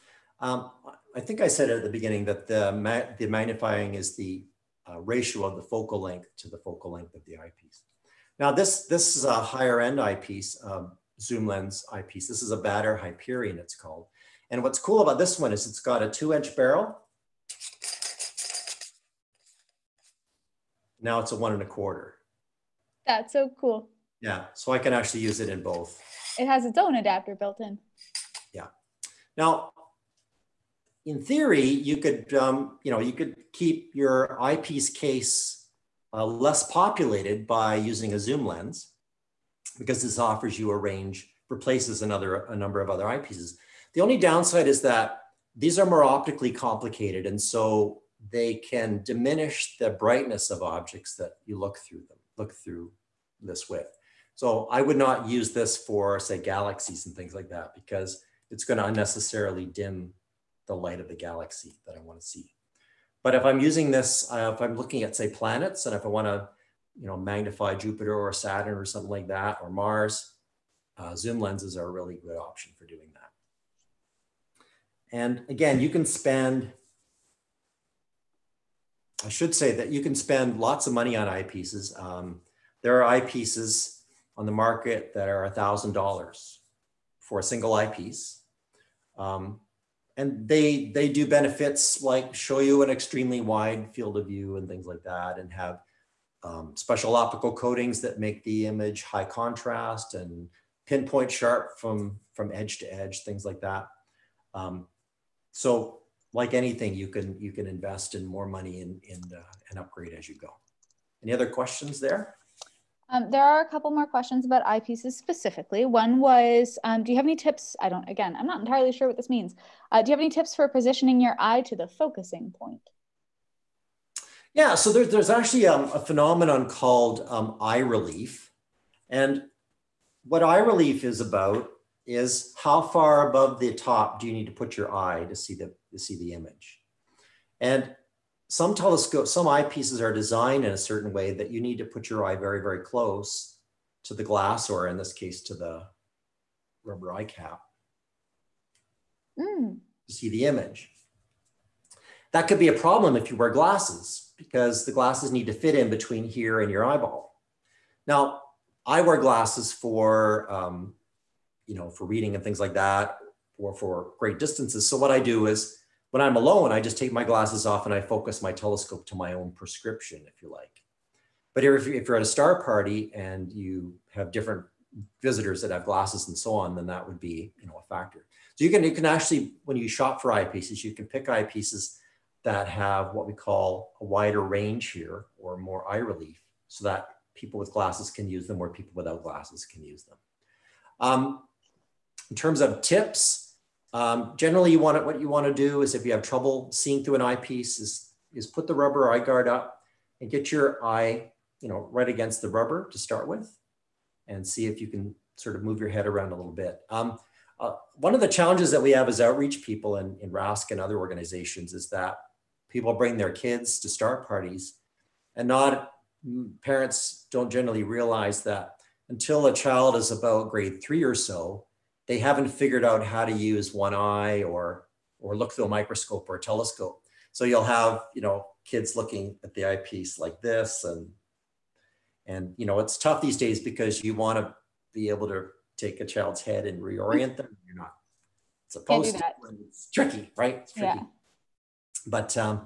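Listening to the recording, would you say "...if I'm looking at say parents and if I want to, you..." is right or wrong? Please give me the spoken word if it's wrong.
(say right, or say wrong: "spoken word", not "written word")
wrong: "planets", not "parents".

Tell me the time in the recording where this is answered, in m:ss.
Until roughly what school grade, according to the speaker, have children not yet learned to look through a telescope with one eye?
3:40.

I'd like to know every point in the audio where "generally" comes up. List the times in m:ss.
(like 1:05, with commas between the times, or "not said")
3:14, 3:37.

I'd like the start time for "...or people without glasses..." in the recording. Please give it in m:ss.
3:08.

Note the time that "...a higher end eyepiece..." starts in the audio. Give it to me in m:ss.
0:09.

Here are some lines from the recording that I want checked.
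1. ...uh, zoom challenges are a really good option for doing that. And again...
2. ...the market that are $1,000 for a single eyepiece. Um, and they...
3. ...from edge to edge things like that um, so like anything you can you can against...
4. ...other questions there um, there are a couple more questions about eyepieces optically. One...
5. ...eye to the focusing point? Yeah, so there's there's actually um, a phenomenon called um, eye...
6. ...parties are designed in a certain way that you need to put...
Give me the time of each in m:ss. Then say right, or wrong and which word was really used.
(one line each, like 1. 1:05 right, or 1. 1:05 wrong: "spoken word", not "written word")
1. 1:10 wrong: "lenses", not "challenges"
2. 1:24 right
3. 1:42 wrong: "invest", not "against"
4. 1:51 wrong: "specifically", not "optically"
5. 2:01 right
6. 2:19 wrong: "eyepieces", not "parties".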